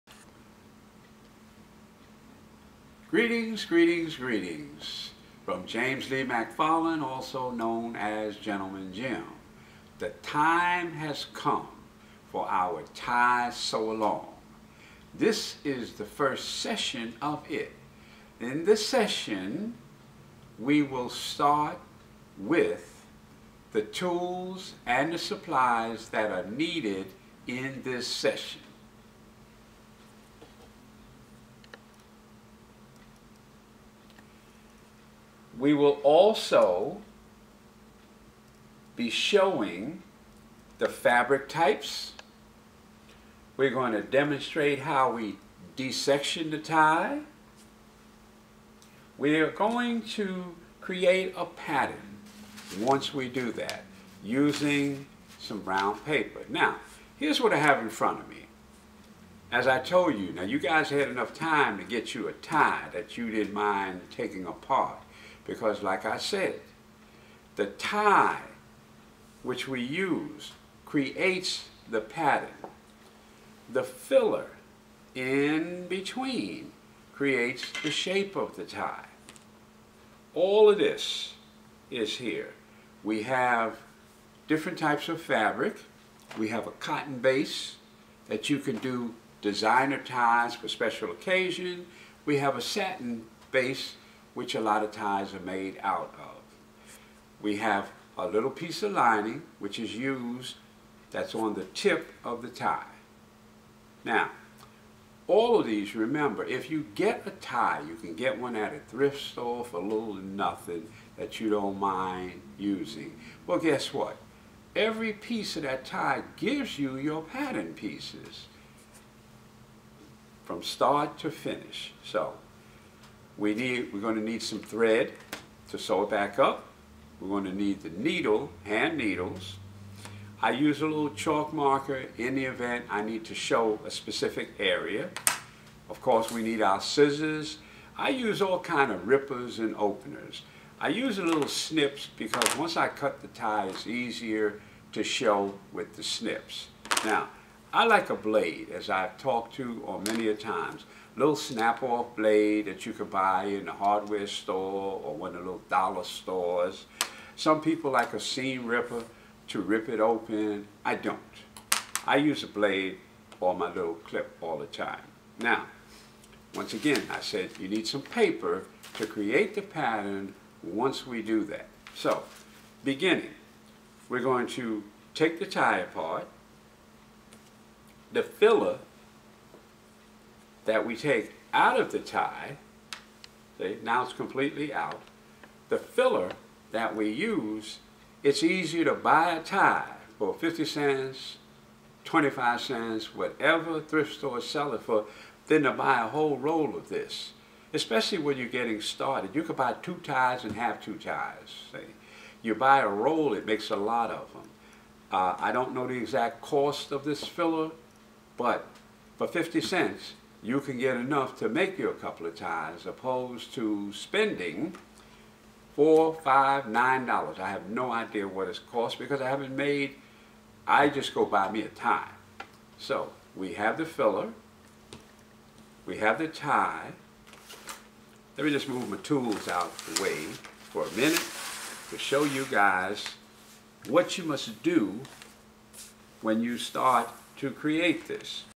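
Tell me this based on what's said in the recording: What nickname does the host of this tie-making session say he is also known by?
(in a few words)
Gentleman Jim.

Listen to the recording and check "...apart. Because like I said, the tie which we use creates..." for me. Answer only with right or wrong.
right.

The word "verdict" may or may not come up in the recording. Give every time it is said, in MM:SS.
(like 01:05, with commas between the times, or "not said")
not said.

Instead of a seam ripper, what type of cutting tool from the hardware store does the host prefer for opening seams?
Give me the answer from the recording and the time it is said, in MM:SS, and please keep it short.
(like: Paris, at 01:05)
snap-off blade, at 02:31.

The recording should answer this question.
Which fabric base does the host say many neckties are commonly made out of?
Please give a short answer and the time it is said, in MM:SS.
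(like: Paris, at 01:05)
satin, at 01:32.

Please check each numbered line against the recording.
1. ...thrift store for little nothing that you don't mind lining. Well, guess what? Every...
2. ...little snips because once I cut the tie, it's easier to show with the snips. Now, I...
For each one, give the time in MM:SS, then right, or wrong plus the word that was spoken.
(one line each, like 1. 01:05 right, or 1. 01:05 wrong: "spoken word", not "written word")
1. 01:48 wrong: "using", not "lining"
2. 02:21 right.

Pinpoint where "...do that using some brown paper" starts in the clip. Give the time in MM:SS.
00:53.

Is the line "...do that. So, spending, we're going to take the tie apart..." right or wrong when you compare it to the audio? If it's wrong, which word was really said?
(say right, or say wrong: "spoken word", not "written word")
wrong: "beginning", not "spending".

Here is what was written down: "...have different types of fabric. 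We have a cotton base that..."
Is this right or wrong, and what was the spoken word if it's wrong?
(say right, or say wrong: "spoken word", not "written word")
right.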